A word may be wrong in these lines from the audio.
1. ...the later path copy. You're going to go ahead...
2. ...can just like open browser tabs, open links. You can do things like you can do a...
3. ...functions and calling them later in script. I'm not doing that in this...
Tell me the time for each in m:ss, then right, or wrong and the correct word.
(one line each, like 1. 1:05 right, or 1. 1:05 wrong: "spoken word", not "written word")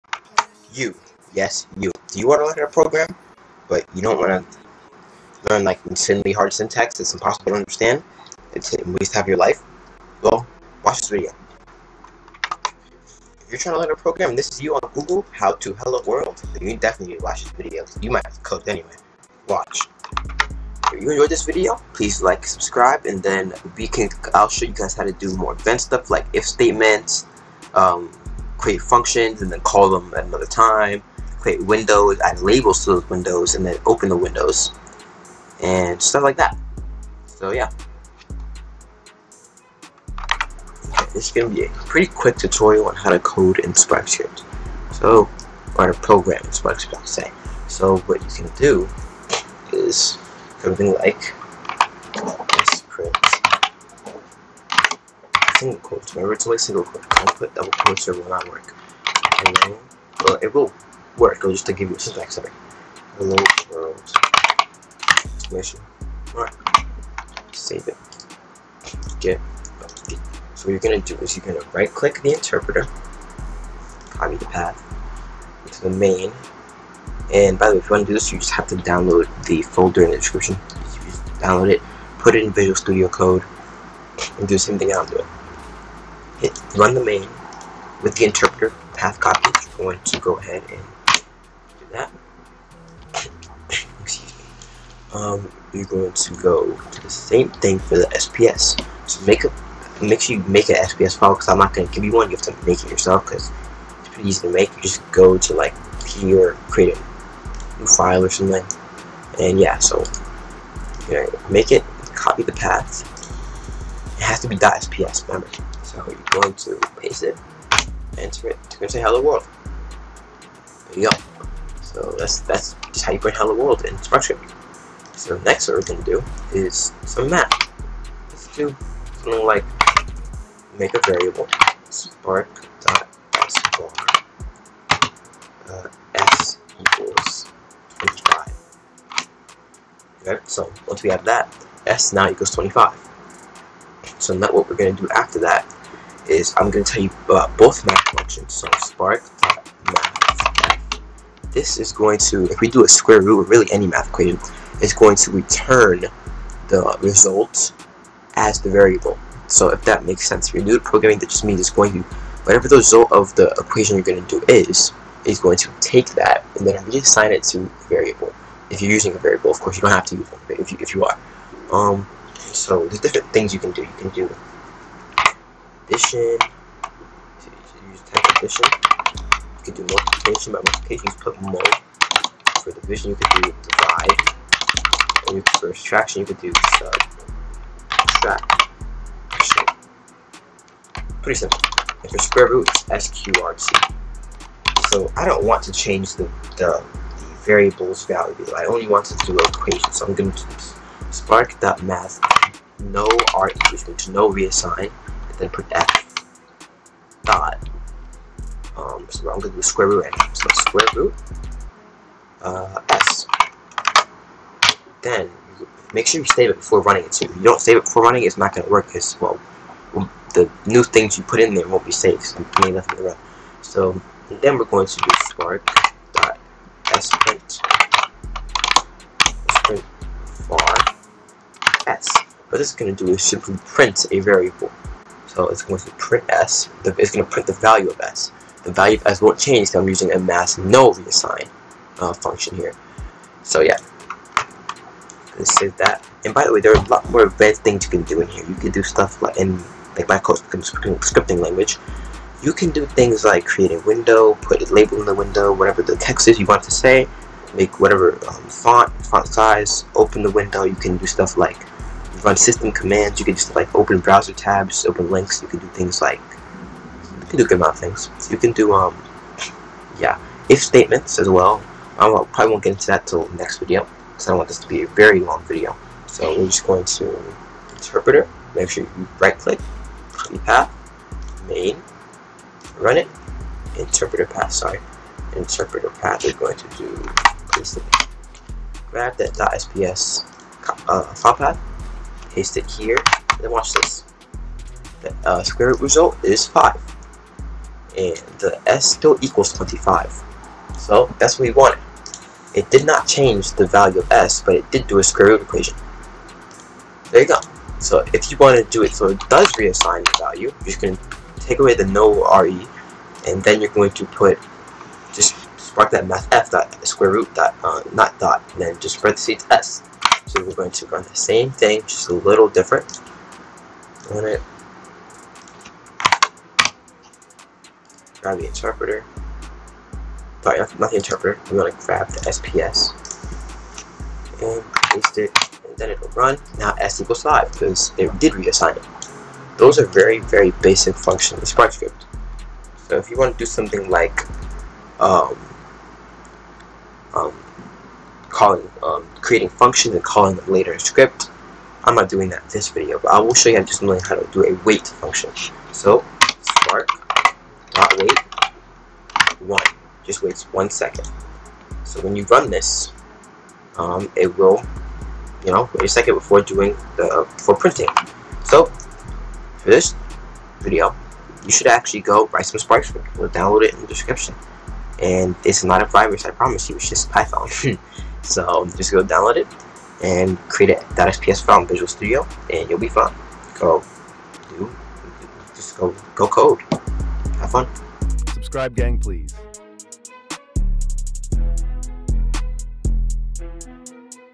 1. 1:28 wrong: "interpreter", not "later"
2. 4:23 right
3. 5:49 right.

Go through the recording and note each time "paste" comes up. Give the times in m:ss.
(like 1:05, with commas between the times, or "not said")
1:57, 4:52, 5:34.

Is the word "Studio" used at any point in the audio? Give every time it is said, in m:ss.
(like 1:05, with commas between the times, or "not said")
1:22, 6:21.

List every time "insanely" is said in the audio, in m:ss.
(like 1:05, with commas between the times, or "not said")
0:05.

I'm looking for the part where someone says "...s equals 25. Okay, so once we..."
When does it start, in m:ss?
2:16.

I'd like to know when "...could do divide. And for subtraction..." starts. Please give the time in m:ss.
3:03.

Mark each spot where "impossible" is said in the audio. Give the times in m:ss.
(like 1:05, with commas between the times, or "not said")
0:07.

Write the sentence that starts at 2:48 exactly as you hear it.
If you're using a variable, of course, you don't have to use one if you, if you are.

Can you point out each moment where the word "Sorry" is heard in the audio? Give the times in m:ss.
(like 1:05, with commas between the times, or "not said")
4:44, 5:30.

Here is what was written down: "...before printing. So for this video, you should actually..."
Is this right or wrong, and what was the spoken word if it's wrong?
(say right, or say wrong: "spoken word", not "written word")
right.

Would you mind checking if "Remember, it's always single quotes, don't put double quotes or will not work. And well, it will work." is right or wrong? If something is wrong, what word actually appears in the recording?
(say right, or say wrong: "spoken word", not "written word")
right.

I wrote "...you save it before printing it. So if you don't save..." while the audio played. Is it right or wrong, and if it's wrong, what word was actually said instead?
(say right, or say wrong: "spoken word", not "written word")
wrong: "running", not "printing".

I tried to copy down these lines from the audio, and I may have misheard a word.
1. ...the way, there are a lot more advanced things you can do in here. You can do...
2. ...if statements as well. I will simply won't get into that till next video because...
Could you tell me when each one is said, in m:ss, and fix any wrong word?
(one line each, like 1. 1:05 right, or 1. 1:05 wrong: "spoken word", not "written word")
1. 4:06 right
2. 4:30 wrong: "probably", not "simply".